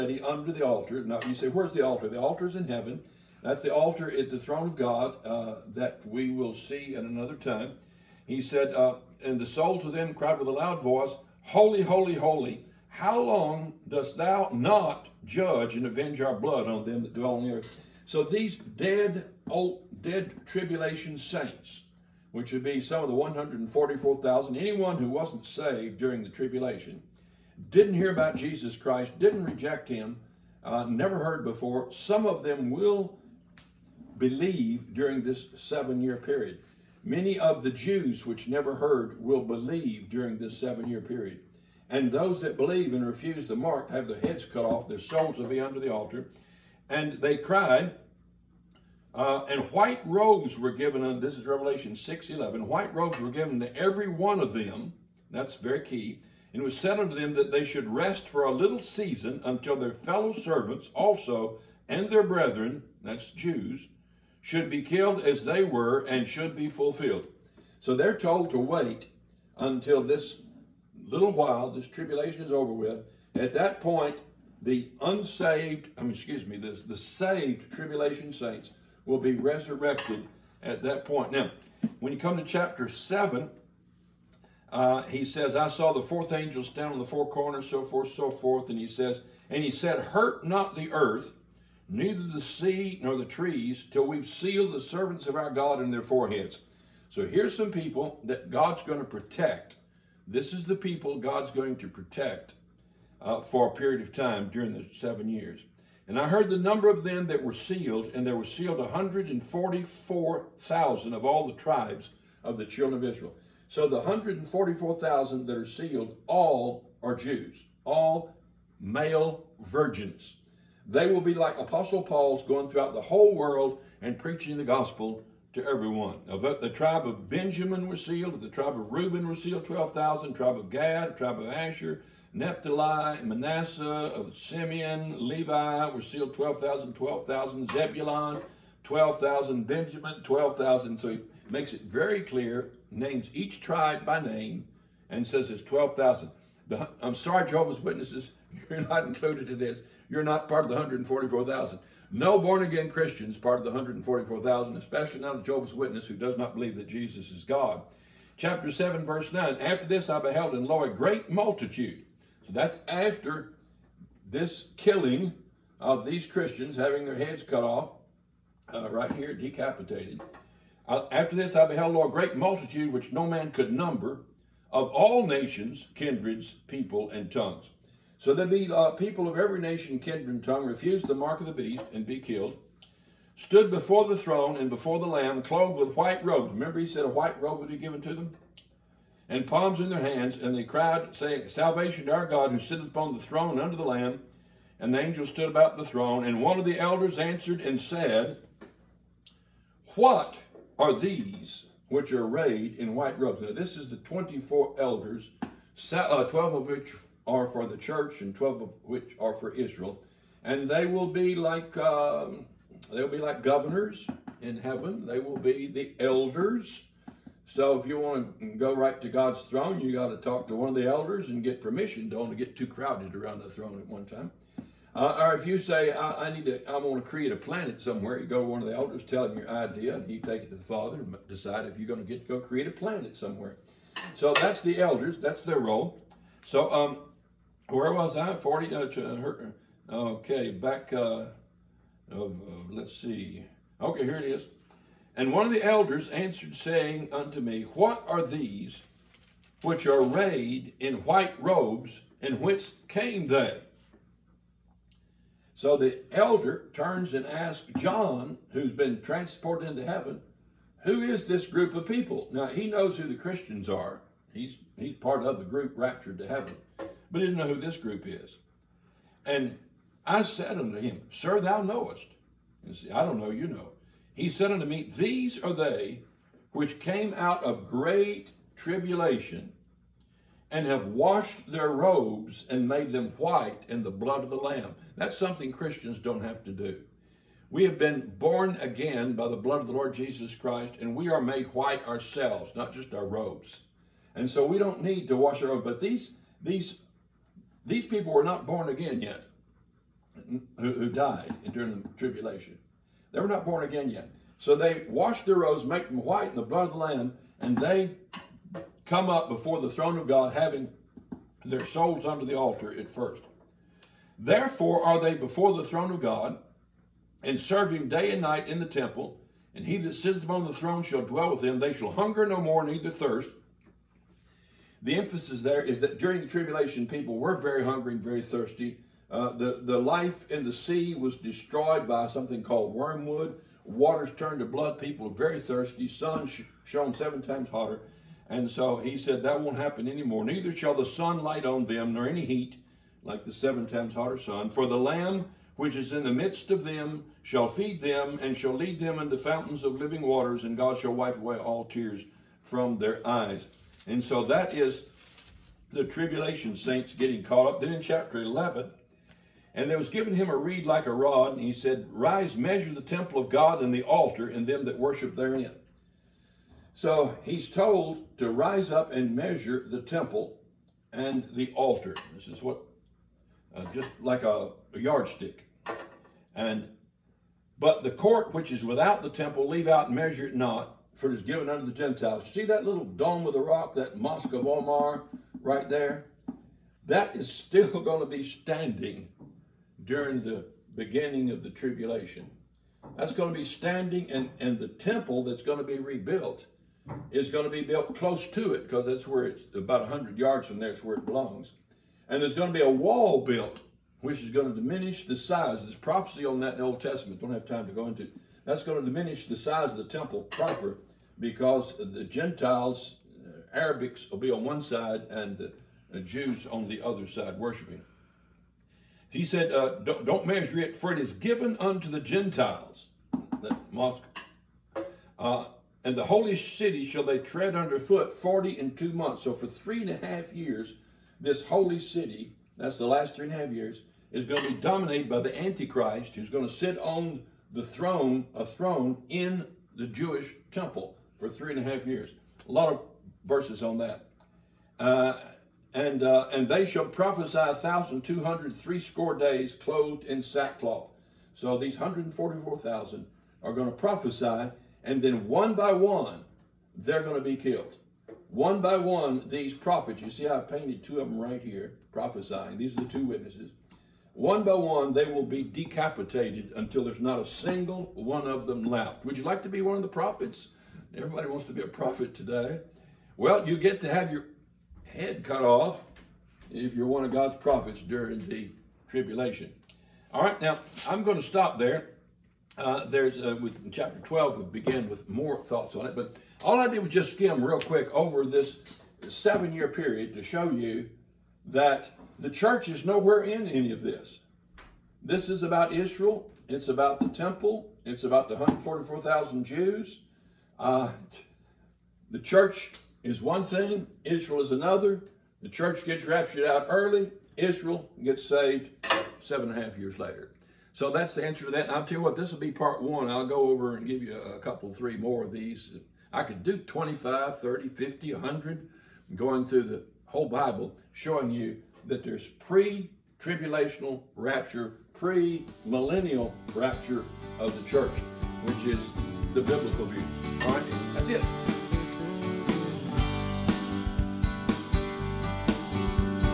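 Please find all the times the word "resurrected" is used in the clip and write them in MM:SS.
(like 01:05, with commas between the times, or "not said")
01:19.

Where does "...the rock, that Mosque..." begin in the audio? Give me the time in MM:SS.
06:23.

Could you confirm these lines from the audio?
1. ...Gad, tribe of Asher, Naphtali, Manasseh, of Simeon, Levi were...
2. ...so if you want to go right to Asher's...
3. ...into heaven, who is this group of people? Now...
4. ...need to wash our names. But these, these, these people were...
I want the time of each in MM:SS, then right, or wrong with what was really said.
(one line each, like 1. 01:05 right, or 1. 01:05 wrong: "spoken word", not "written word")
1. 02:10 right
2. 03:37 wrong: "God", not "Asher"
3. 04:19 right
4. 04:54 wrong: "robes", not "names".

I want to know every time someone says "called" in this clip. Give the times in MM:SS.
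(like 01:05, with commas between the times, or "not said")
05:32.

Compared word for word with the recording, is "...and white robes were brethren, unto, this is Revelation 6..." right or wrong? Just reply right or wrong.
wrong.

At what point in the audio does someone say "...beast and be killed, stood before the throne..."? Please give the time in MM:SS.
03:01.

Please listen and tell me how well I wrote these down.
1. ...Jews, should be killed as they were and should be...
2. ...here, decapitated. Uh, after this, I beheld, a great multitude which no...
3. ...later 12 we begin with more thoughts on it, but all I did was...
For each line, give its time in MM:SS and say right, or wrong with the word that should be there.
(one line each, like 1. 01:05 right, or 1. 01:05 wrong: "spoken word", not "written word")
1. 01:03 right
2. 02:49 right
3. 08:03 wrong: "chapter", not "later".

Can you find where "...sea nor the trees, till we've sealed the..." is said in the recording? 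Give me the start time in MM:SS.
01:32.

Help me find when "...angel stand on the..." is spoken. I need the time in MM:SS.
01:26.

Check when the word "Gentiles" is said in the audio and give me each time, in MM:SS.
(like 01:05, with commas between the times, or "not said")
06:21, 06:52, 07:01.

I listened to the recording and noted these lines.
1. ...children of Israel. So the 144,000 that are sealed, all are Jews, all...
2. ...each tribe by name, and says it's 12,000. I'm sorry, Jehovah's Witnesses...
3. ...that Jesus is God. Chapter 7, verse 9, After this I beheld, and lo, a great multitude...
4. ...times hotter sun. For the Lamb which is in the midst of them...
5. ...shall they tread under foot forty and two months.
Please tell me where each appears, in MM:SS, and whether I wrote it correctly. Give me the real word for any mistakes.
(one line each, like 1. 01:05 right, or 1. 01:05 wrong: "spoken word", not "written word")
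1. 01:52 right
2. 02:23 right
3. 02:36 right
4. 05:43 right
5. 07:06 right.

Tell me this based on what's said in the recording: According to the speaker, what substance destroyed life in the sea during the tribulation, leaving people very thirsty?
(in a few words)
Wormwood.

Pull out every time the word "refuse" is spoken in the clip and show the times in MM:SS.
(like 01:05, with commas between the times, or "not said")
00:43, 03:00.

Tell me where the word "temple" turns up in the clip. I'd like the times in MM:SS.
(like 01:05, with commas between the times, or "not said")
05:18, 06:02, 06:09, 06:19, 06:34, 06:49, 07:20, 08:17.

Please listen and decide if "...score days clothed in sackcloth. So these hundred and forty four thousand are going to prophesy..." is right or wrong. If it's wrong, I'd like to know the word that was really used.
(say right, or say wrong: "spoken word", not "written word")
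right.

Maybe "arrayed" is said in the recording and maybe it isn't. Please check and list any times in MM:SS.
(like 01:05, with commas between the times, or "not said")
03:22, 04:10.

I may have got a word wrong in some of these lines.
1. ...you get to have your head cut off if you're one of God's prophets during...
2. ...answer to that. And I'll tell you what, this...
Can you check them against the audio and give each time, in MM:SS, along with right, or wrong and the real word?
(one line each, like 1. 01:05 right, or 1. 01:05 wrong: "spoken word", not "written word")
1. 07:53 right
2. 08:31 right.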